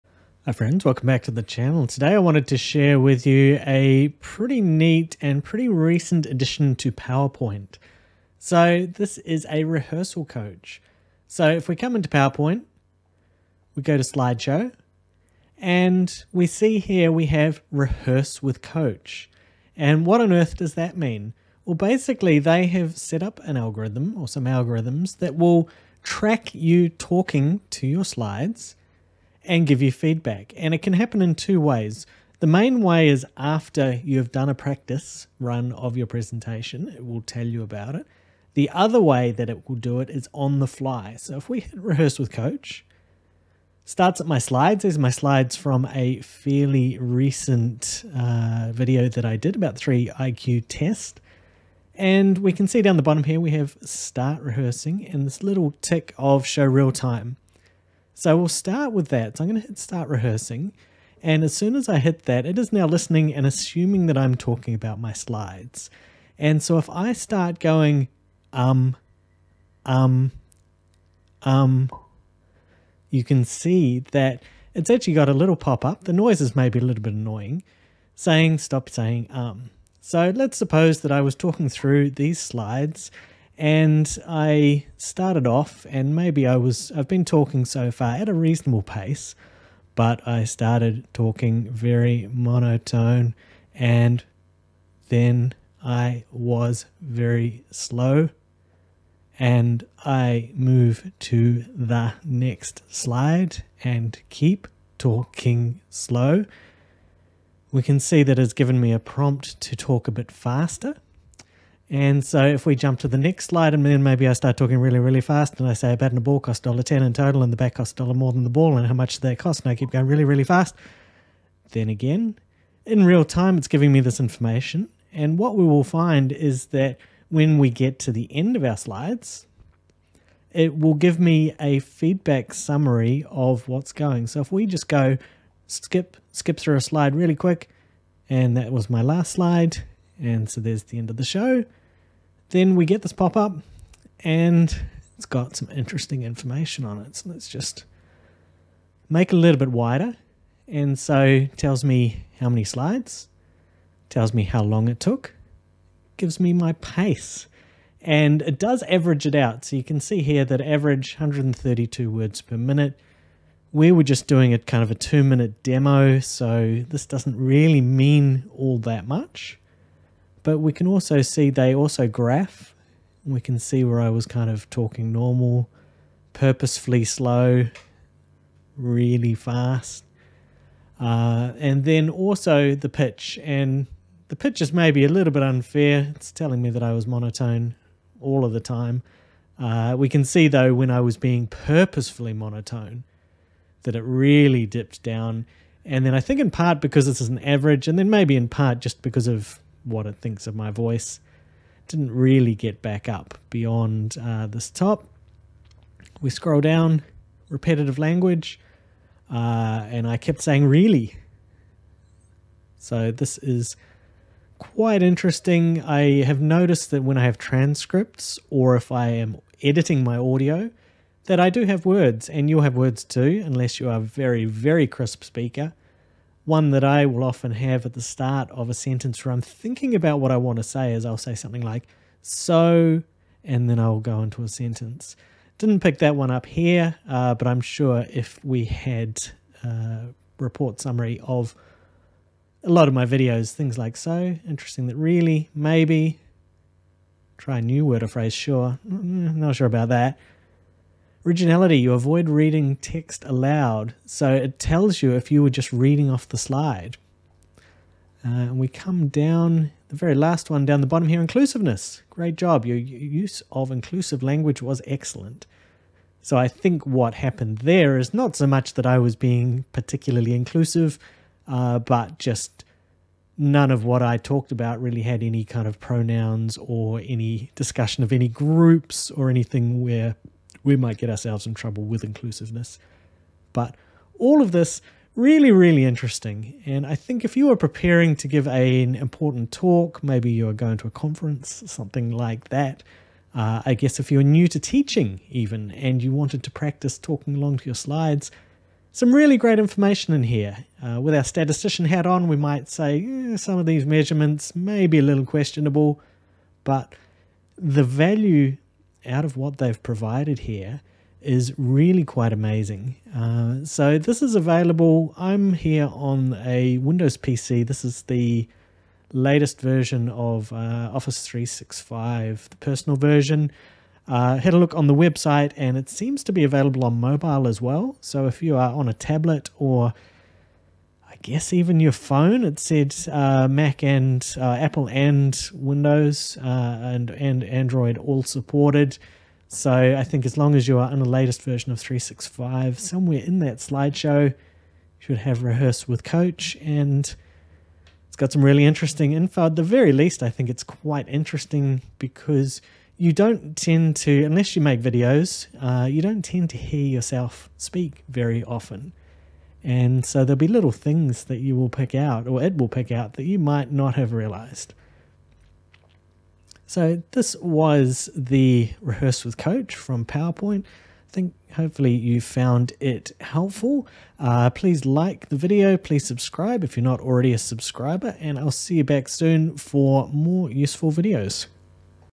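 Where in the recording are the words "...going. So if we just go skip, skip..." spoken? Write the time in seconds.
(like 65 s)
133 s.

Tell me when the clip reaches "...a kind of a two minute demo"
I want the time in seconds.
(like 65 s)
164 s.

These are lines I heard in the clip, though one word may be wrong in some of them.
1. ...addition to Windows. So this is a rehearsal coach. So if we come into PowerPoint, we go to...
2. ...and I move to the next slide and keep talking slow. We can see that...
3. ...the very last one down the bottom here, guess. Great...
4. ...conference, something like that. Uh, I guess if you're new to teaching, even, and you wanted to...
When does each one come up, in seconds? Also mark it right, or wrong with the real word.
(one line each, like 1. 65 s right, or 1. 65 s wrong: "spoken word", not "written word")
1. 6 s wrong: "PowerPoint", not "Windows"
2. 99 s right
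3. 259 s wrong: "inclusiveness", not "guess"
4. 290 s right.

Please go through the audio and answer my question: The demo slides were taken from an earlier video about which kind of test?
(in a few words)
IQ test.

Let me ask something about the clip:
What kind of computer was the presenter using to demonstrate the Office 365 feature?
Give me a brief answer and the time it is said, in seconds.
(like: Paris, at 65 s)
Windows PC, at 316 s.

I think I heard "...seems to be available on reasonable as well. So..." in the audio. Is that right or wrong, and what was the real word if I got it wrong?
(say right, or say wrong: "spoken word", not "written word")
wrong: "mobile", not "reasonable".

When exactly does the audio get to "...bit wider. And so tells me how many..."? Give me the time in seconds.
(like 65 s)
149 s.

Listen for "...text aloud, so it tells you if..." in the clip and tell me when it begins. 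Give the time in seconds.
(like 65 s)
252 s.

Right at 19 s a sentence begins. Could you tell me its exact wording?
And what on earth does that mean?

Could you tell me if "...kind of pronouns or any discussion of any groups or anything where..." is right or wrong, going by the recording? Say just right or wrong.
right.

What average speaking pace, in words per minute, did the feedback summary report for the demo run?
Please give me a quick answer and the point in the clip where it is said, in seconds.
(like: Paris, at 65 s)
132, at 161 s.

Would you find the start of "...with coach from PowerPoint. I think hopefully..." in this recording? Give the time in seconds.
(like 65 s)
369 s.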